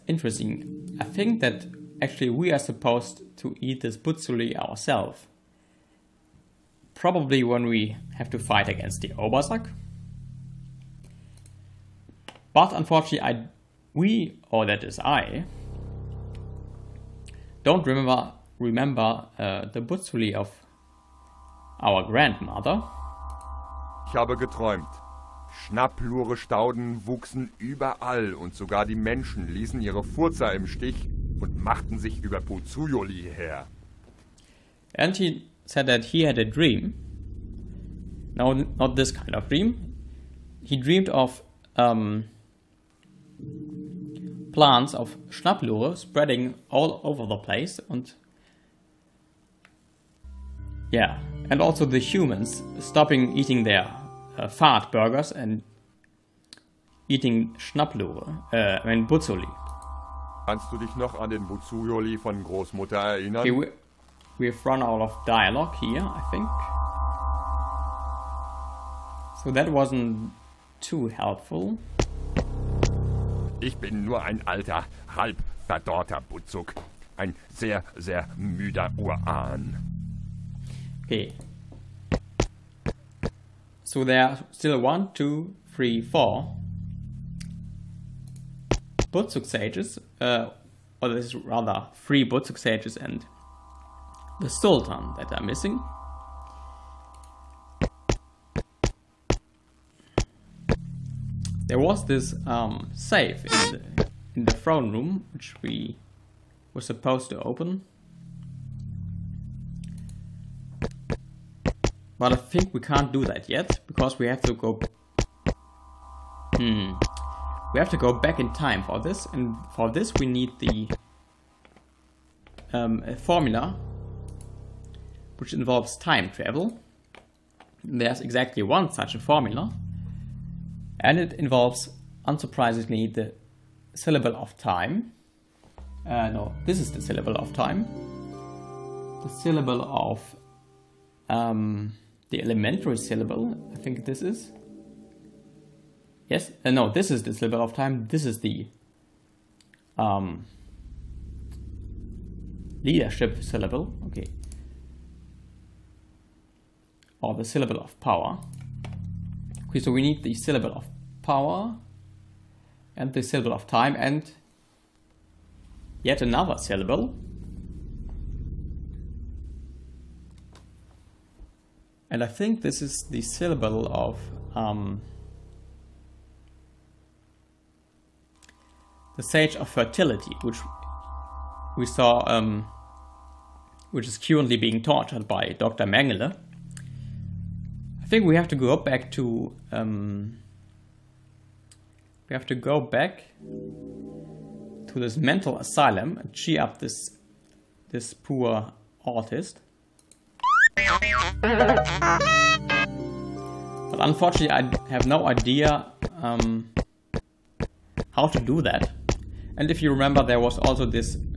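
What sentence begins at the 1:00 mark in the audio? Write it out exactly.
Kannst du dich noch an den Butzuli von Großmutter erinnern?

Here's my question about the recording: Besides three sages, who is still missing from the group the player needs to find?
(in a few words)
the Sultan.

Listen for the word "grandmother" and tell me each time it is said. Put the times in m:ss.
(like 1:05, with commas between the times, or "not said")
0:22.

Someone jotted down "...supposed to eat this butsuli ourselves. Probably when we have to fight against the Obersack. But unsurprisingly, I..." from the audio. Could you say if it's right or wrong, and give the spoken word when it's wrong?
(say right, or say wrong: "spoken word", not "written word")
wrong: "unfortunately", not "unsurprisingly".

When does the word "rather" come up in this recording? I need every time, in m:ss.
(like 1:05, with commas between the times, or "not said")
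1:31.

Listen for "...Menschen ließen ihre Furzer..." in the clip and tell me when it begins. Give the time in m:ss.
0:28.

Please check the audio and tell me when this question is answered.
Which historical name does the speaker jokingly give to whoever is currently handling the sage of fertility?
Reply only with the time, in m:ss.
3:05.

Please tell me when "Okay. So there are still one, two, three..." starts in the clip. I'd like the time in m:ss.
1:21.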